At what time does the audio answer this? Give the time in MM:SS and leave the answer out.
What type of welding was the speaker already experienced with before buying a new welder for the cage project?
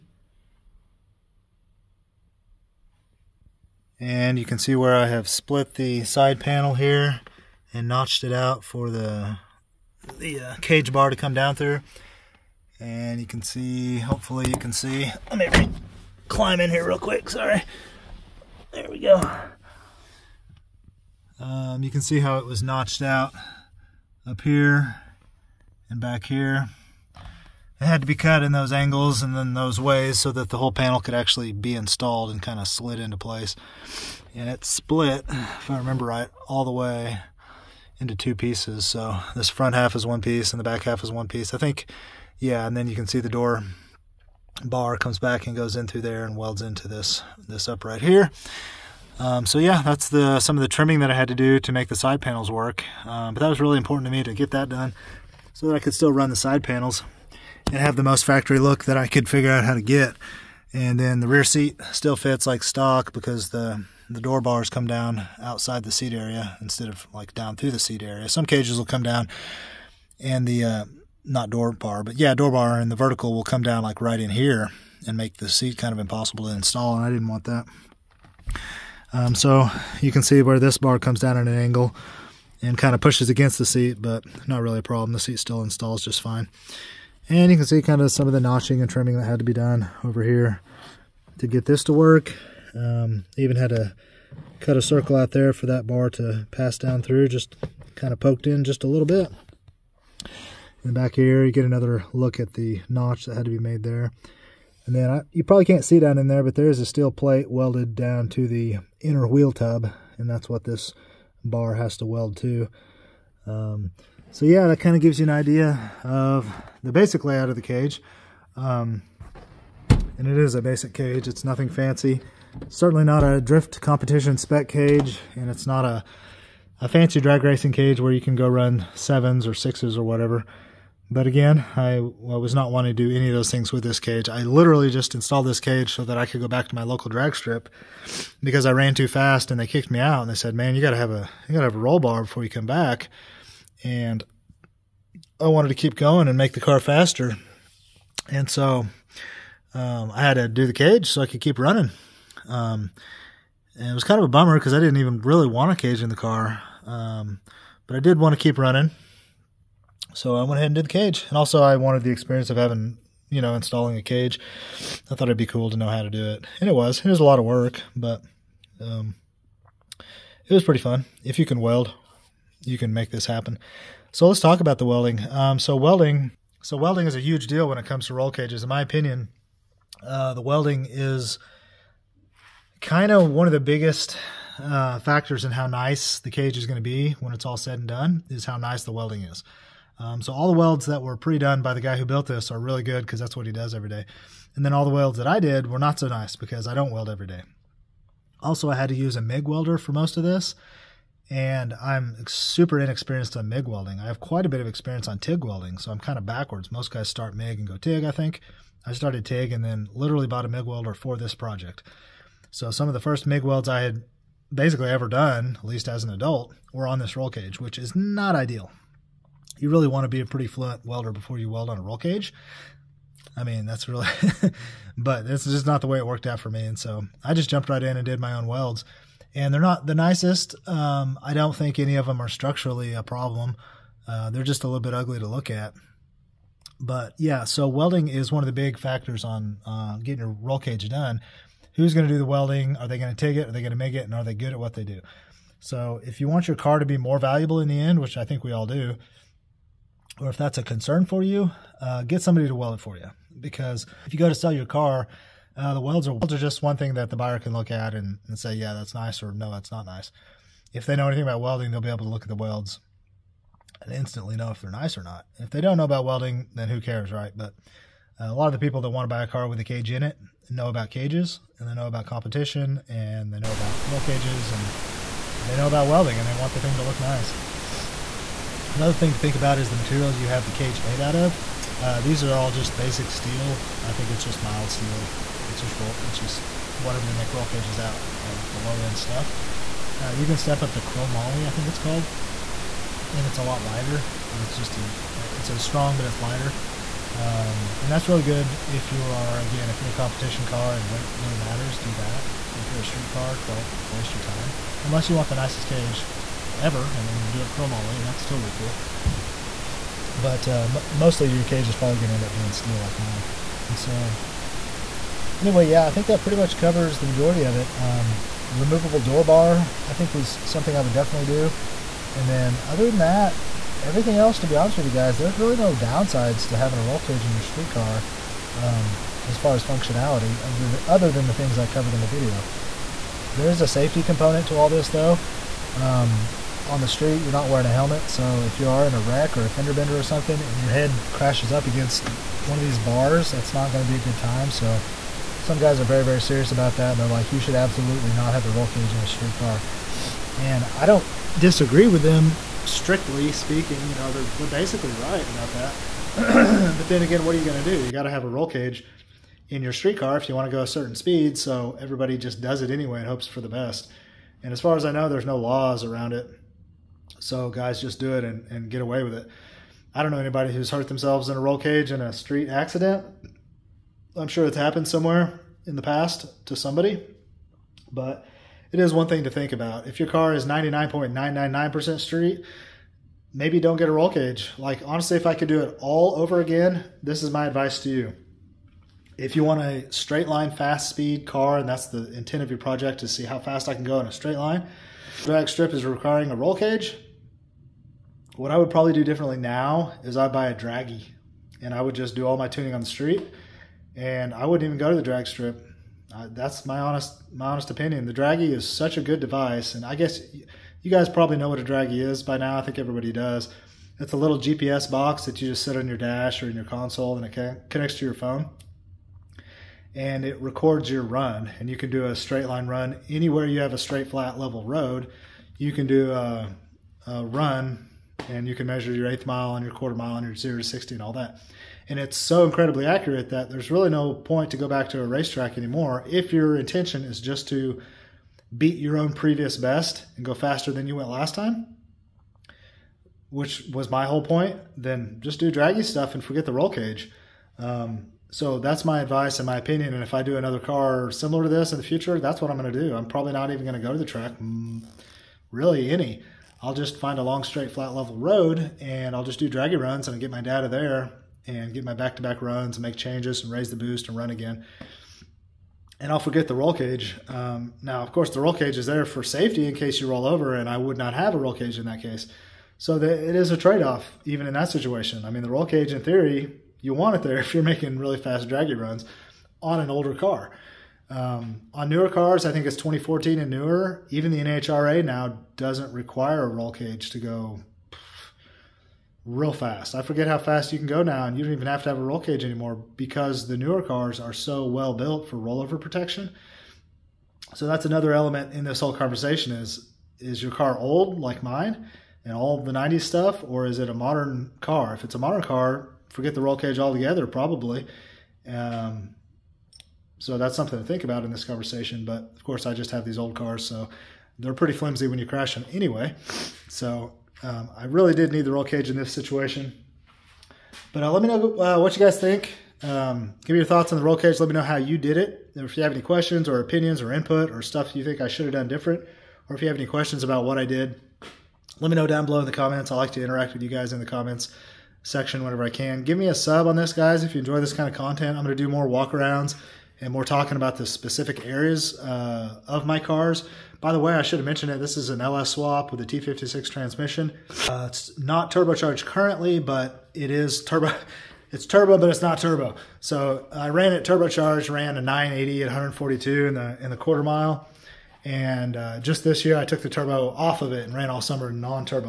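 03:25.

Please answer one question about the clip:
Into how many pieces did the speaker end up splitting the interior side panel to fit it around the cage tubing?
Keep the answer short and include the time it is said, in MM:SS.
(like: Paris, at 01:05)
2, at 00:38.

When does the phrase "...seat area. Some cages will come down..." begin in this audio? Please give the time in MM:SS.
01:07.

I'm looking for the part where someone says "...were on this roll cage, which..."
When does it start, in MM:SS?
03:36.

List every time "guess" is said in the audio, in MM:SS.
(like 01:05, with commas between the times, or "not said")
06:49.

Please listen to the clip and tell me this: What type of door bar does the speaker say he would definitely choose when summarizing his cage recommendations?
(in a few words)
Removable.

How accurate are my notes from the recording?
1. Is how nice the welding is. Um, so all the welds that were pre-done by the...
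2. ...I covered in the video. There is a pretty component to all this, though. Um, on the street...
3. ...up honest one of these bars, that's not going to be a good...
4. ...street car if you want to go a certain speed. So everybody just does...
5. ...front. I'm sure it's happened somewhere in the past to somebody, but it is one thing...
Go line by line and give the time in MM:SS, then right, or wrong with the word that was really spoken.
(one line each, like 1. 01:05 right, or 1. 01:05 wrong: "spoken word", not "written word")
1. 03:08 right
2. 05:31 wrong: "safety", not "pretty"
3. 05:41 wrong: "against", not "honest"
4. 05:59 right
5. 06:12 wrong: "accident", not "front".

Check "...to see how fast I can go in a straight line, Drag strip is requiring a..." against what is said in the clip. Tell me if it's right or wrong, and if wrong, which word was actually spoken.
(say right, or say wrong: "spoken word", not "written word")
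right.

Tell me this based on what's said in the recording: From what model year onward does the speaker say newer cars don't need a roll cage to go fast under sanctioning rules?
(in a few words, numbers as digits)
2014.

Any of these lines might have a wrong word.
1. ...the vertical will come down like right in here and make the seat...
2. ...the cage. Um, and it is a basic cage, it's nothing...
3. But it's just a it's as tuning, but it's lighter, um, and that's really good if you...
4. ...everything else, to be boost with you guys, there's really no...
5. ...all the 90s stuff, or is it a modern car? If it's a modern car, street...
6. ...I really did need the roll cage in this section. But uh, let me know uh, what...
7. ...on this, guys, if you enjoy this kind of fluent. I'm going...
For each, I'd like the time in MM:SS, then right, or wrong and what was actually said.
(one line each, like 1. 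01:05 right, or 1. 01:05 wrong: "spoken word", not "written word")
1. 01:12 right
2. 01:57 right
3. 04:54 wrong: "strong", not "tuning"
4. 05:23 wrong: "honest", not "boost"
5. 08:22 wrong: "forget", not "street"
6. 08:37 wrong: "situation", not "section"
7. 08:56 wrong: "content", not "fluent".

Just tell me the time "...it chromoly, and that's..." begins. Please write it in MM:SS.
05:07.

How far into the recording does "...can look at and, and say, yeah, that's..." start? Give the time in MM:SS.
04:17.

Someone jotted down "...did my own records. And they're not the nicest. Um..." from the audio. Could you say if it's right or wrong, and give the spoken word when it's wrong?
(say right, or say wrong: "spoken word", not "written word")
wrong: "welds", not "records".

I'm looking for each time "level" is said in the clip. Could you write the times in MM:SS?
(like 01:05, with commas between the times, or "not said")
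07:04, 07:37.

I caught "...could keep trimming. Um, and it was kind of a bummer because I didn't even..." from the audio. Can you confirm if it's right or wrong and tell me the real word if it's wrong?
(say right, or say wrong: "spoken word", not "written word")
wrong: "running", not "trimming".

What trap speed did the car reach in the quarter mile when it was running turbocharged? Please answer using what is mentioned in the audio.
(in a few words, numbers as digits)
142.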